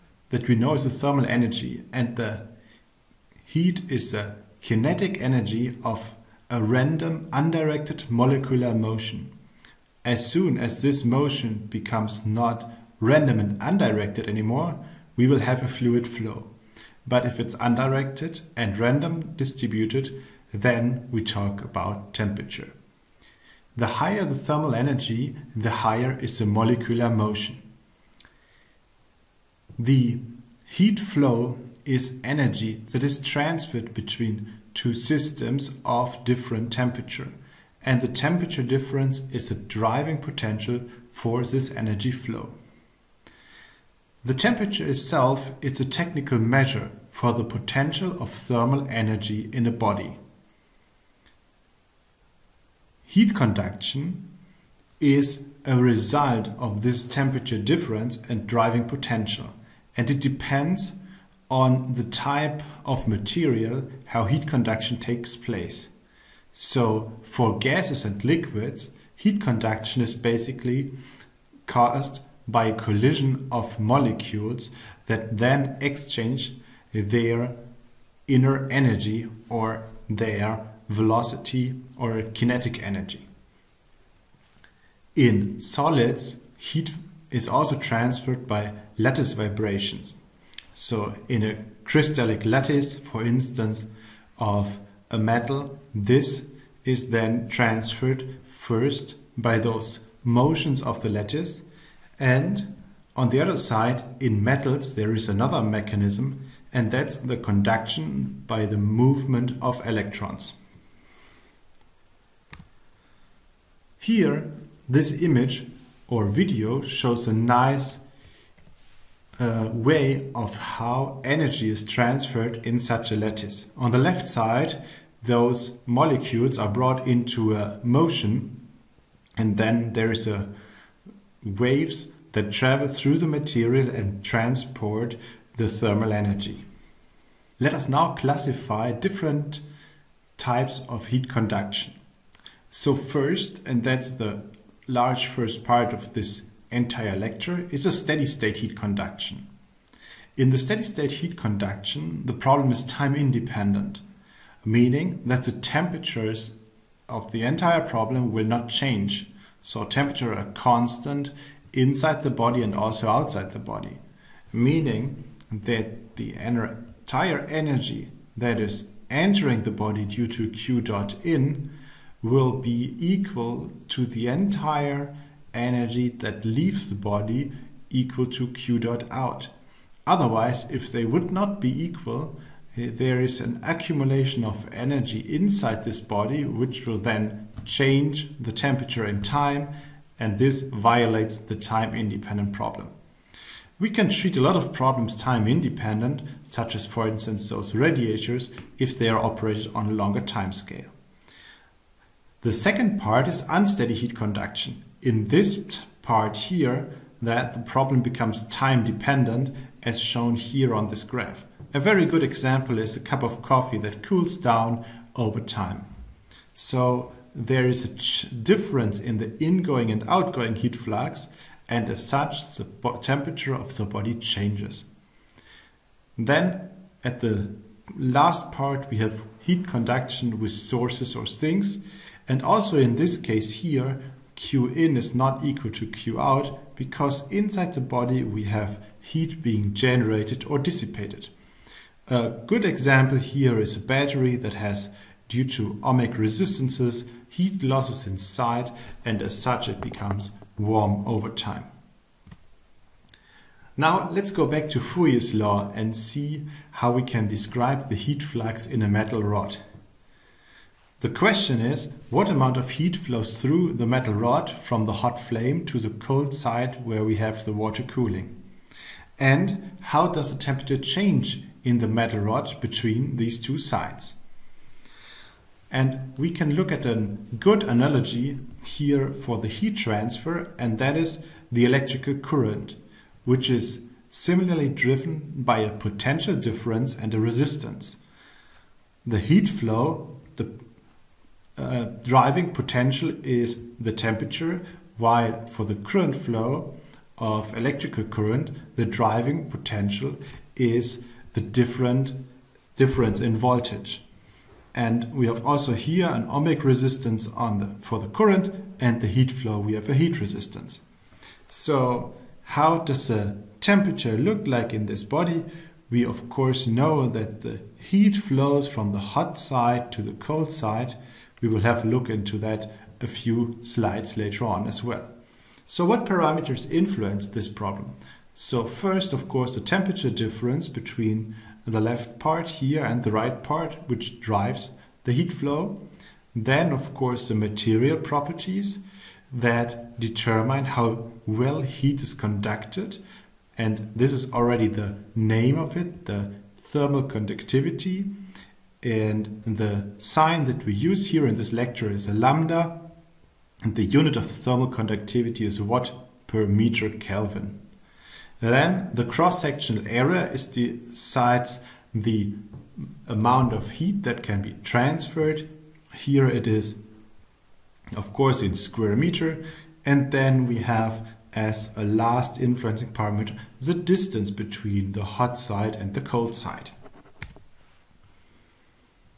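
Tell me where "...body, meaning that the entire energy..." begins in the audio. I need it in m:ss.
2:43.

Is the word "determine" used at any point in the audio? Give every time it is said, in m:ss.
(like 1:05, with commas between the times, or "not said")
5:39.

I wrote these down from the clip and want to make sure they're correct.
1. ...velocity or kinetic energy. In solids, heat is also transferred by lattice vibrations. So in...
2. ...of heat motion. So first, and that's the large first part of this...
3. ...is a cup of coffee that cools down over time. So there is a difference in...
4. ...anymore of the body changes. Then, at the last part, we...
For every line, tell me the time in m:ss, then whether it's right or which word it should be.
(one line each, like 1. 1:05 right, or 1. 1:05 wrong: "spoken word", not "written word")
1. 1:20 right
2. 2:20 wrong: "conduction", not "motion"
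3. 3:32 right
4. 3:43 wrong: "temperature", not "anymore".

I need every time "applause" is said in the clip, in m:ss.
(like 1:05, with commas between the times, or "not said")
not said.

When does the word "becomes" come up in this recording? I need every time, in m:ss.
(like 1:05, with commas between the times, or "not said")
0:11, 3:28, 4:09.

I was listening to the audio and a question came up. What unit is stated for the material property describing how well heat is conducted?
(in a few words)
watt per meter Kelvin.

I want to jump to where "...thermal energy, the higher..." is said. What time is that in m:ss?
0:24.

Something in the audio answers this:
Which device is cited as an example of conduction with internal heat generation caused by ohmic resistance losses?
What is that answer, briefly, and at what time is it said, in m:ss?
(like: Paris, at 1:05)
battery, at 4:03.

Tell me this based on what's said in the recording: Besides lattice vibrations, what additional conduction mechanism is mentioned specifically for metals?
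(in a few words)
movement of electrons.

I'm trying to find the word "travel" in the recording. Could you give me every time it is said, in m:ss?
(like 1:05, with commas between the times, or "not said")
2:12.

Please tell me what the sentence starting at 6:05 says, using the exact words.
Here it is, of course, in square meter.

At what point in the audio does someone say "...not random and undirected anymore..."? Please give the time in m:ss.
0:12.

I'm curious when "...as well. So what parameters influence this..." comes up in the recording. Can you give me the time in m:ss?
5:24.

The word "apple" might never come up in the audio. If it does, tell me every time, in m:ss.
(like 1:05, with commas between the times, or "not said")
not said.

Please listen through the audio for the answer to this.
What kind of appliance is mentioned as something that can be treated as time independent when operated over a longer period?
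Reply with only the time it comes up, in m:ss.
3:17.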